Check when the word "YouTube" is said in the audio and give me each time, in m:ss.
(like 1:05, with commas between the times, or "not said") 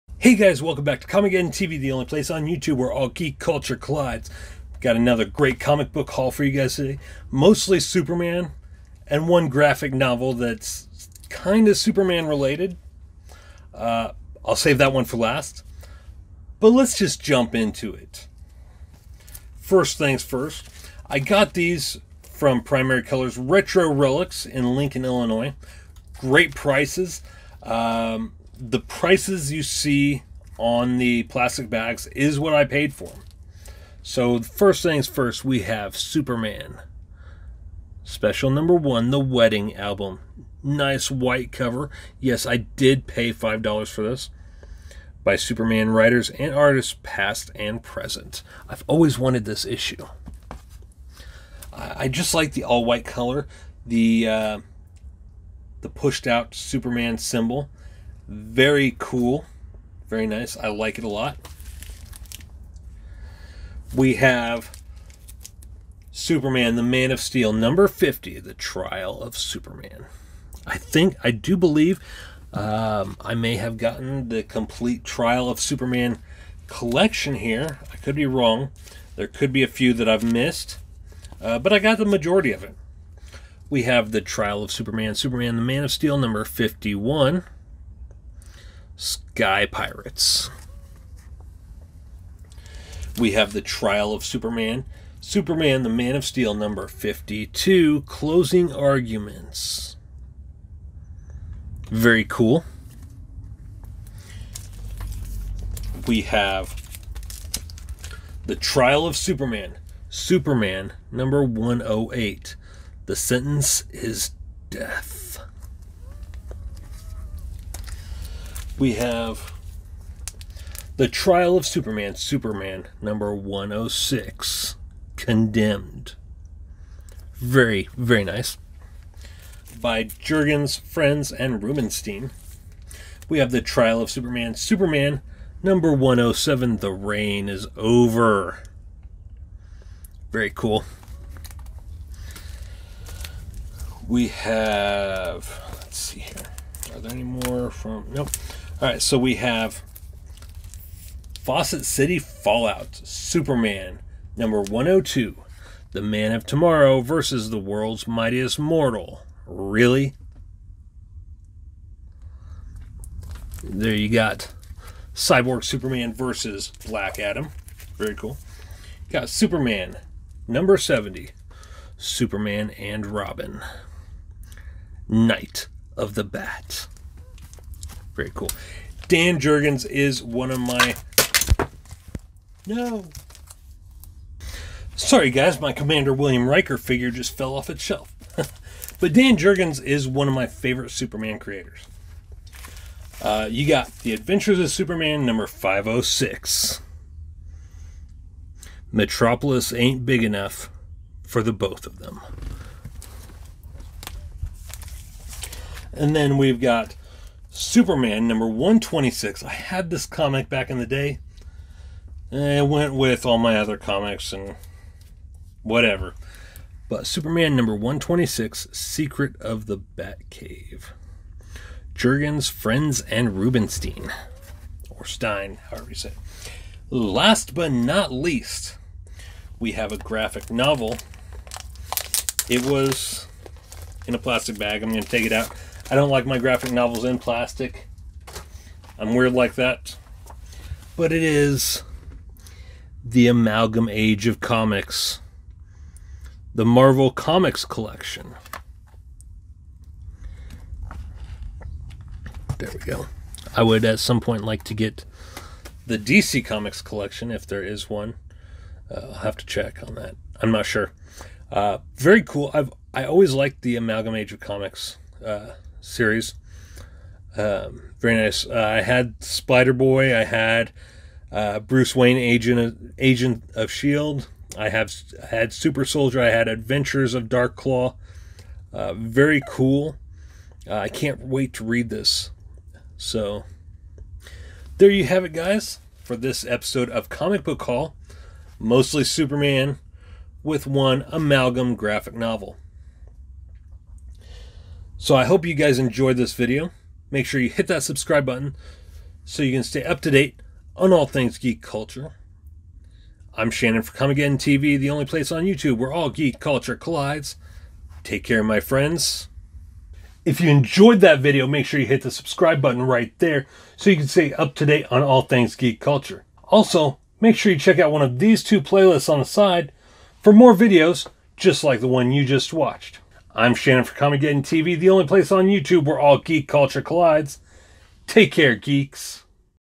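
0:02, 5:05, 5:25.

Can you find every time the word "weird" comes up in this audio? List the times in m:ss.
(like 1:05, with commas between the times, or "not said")
3:59.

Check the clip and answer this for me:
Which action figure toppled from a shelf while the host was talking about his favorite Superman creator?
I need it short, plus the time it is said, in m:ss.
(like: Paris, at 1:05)
Commander William Riker, at 3:05.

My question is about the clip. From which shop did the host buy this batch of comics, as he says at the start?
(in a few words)
Primary Colors Retro Relics.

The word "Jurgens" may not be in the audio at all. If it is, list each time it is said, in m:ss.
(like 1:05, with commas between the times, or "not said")
2:10, 2:59, 3:09, 3:41.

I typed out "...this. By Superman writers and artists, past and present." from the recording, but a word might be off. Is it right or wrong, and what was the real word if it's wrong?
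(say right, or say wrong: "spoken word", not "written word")
right.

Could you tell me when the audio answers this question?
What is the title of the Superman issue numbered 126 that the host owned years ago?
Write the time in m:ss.
3:38.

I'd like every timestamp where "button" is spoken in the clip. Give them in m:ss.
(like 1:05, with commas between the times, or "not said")
4:58, 5:12.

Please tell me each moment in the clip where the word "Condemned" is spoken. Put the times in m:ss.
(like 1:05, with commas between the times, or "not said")
2:05.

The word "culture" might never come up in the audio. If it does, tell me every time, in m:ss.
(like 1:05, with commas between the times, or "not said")
0:03, 5:01, 5:06, 5:15, 5:26.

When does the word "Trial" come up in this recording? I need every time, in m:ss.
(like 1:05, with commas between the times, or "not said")
1:08, 1:15, 1:24, 1:33, 1:48, 2:01, 2:13.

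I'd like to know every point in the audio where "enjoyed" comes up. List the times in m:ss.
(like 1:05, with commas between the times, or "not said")
4:55, 5:10.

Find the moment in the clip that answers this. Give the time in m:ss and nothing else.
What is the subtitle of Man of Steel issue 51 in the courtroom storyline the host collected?
1:29.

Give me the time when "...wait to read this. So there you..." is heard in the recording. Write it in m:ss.
4:41.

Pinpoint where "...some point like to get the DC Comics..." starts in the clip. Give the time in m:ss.
4:13.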